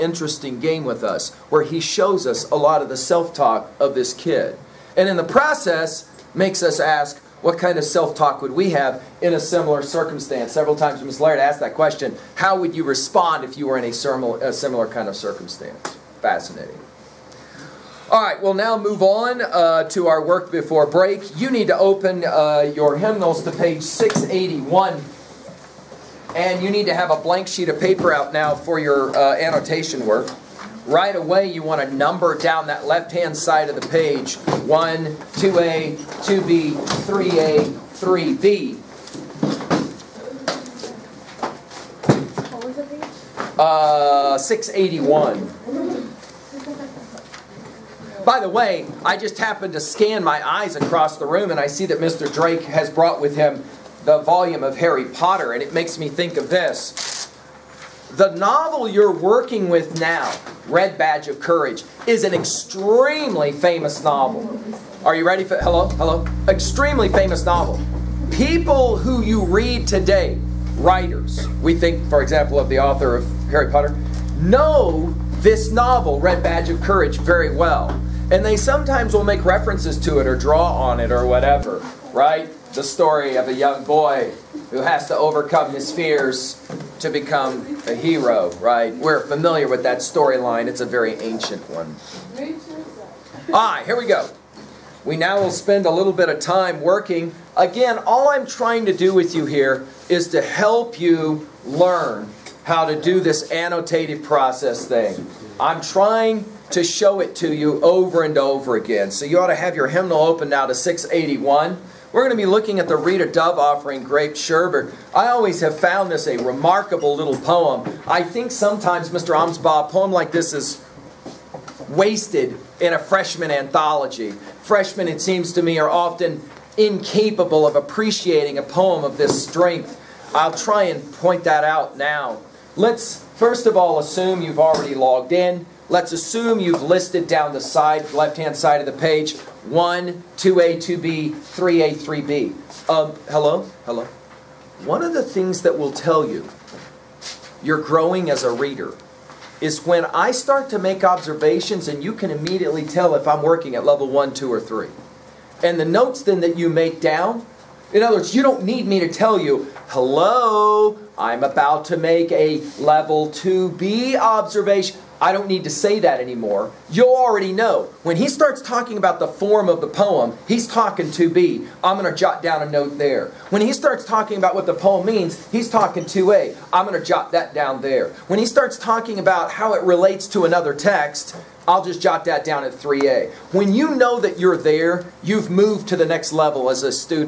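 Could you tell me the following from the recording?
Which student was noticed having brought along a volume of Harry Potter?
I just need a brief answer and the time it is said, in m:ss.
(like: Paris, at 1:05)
Mr. Drake, at 0:51.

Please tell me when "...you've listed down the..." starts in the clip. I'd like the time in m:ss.
2:16.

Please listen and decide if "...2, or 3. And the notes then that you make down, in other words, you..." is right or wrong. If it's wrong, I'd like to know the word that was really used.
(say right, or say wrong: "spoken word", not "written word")
right.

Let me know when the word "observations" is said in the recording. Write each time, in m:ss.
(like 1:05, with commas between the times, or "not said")
2:31, 2:44.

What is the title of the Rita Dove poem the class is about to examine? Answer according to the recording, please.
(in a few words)
Grape Sherbet.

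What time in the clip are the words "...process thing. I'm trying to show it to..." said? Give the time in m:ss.
1:44.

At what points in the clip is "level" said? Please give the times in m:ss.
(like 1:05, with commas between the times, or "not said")
2:33, 2:42, 3:06.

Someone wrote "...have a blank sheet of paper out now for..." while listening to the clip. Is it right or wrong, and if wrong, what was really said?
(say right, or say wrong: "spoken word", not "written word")
right.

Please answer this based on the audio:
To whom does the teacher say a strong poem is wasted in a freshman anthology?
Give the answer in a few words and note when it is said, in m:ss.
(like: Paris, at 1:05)
Mr. Amsbaugh, at 1:59.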